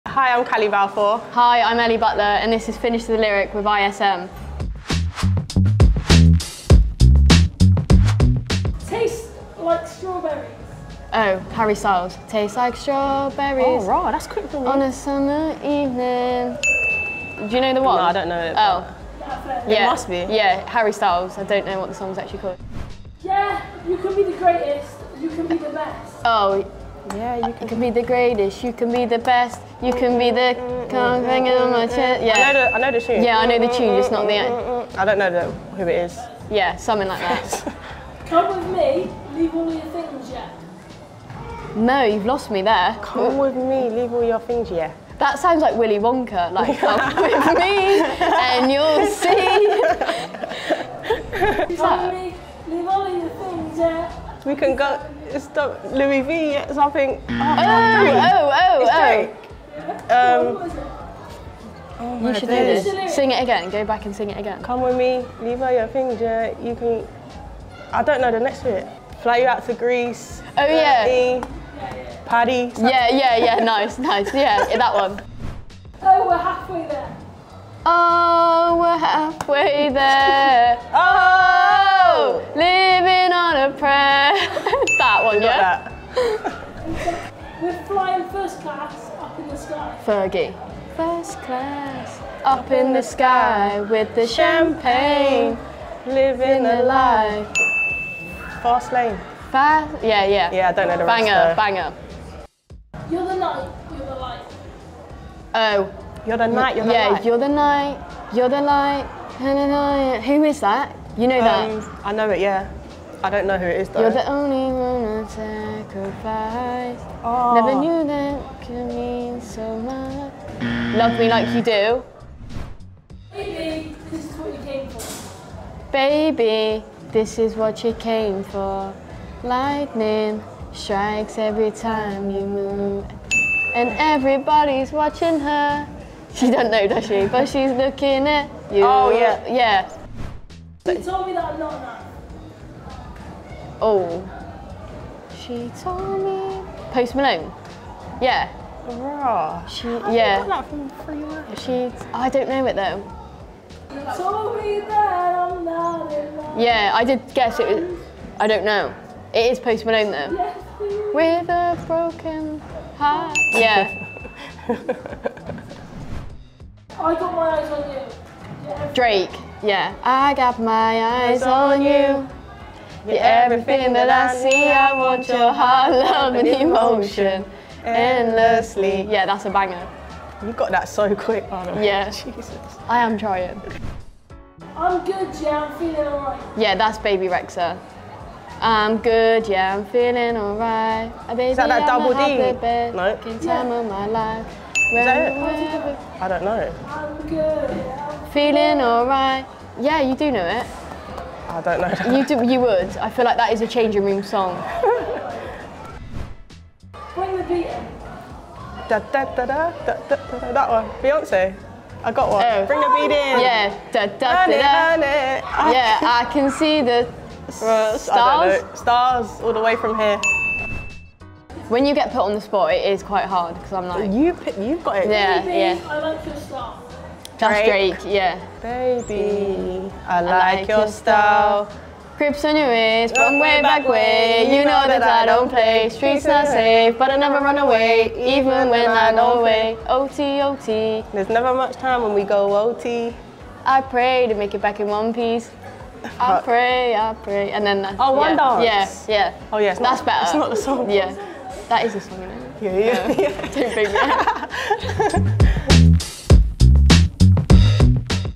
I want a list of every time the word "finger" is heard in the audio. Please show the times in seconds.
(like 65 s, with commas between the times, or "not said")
65 s.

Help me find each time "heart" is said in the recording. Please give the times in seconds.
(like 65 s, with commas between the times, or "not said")
162 s, 175 s.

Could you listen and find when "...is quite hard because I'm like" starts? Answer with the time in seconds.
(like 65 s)
222 s.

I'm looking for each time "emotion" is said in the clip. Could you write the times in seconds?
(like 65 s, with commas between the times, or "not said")
176 s.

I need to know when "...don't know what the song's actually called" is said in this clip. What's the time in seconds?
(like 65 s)
21 s.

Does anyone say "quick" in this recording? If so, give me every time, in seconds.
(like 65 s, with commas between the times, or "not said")
14 s, 181 s.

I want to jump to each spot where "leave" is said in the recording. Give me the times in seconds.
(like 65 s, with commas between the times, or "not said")
39 s, 43 s, 52 s, 65 s.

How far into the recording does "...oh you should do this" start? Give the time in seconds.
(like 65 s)
61 s.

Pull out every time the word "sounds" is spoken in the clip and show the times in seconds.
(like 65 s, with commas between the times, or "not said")
45 s.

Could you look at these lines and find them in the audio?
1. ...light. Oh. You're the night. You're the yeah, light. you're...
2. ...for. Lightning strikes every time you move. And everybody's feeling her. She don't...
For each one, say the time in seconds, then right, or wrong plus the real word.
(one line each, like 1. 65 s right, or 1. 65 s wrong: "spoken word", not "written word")
1. 104 s right
2. 128 s wrong: "watching", not "feeling".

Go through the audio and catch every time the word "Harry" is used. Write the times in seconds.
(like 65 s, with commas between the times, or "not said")
11 s, 20 s.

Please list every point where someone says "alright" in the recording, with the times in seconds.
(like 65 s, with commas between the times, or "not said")
186 s, 190 s, 198 s.